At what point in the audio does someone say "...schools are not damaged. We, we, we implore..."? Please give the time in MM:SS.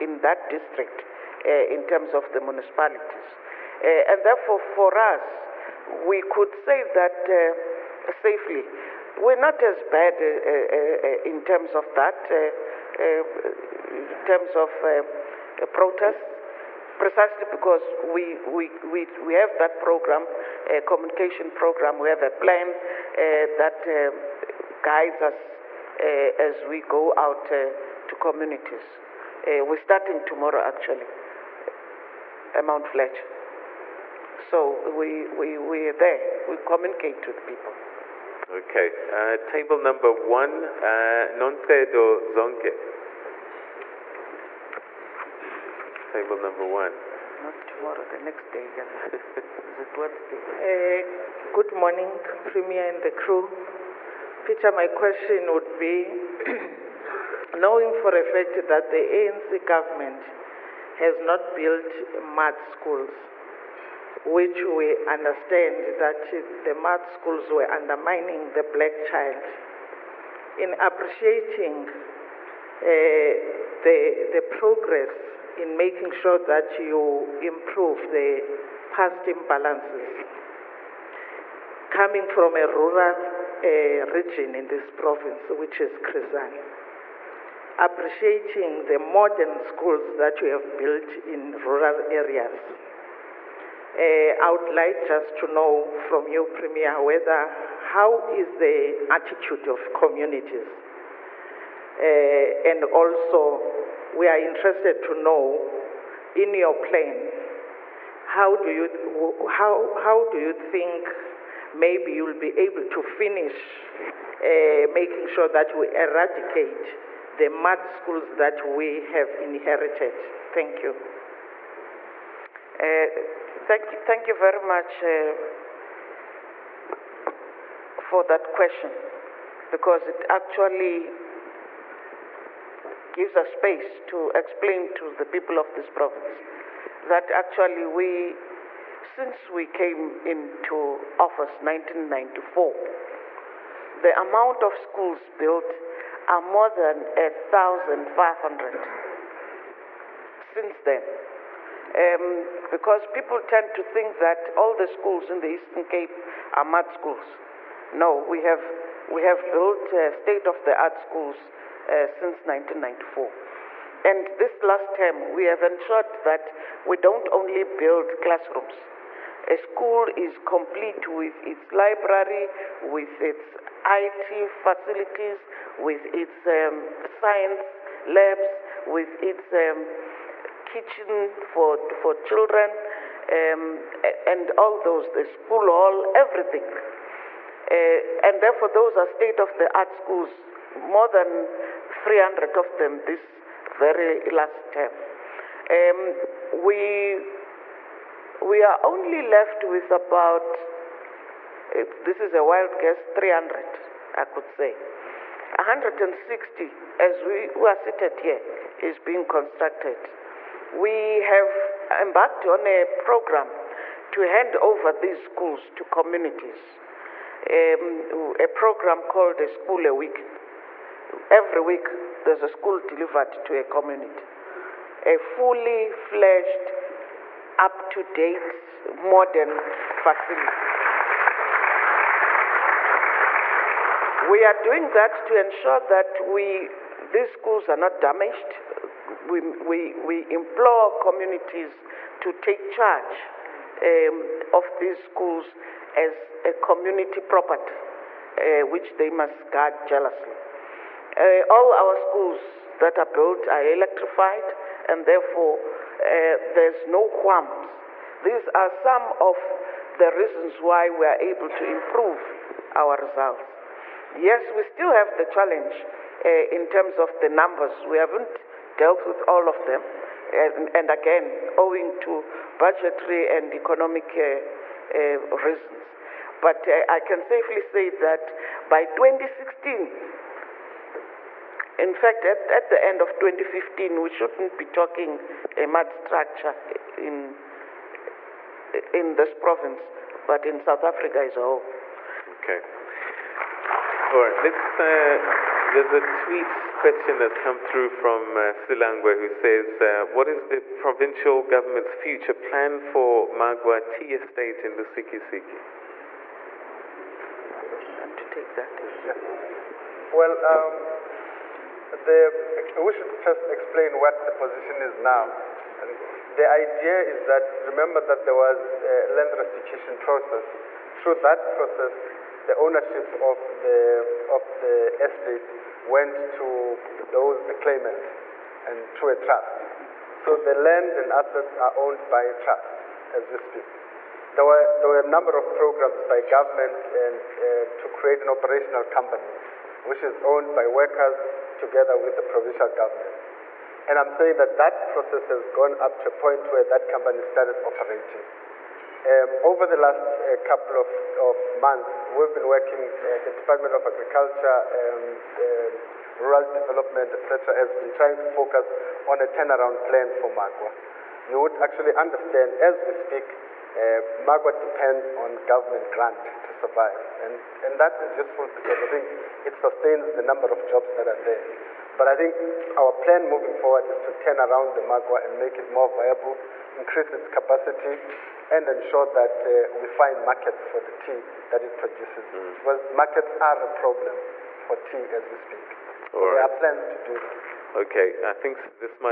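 03:57.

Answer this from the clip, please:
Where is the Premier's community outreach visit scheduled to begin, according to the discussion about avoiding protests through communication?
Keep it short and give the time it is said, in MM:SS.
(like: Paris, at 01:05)
Mount Fletcher, at 00:32.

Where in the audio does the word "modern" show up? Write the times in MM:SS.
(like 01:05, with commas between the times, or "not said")
01:28, 03:48.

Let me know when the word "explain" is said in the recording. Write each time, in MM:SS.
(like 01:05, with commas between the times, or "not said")
02:14, 05:13.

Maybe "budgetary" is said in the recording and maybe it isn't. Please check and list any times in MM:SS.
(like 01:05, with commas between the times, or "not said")
04:32.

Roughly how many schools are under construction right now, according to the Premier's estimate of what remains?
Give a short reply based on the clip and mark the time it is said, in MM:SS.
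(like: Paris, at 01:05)
160, at 03:25.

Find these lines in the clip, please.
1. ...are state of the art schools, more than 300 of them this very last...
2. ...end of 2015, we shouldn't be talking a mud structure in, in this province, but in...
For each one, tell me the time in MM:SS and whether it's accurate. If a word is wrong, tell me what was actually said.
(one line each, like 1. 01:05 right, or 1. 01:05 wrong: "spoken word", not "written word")
1. 03:08 right
2. 04:42 right.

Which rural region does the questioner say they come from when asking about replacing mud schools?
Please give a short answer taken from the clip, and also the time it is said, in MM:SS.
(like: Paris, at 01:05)
Chris Hani, at 01:25.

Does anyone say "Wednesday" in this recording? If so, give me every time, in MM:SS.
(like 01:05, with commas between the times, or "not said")
00:49.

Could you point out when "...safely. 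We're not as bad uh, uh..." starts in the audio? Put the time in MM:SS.
00:08.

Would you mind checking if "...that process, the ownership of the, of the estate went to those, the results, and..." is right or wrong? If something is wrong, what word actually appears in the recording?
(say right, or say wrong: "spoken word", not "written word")
wrong: "claimants", not "results".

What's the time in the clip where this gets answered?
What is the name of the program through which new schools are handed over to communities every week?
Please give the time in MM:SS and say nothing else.
03:39.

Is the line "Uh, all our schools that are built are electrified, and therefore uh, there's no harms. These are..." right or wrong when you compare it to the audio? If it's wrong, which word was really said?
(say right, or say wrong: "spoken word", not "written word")
right.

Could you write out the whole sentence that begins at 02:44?
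And this last term, we have ensured that we don't only build classrooms.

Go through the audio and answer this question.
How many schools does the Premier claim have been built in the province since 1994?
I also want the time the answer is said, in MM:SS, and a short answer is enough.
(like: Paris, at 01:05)
More than 1,500, at 02:26.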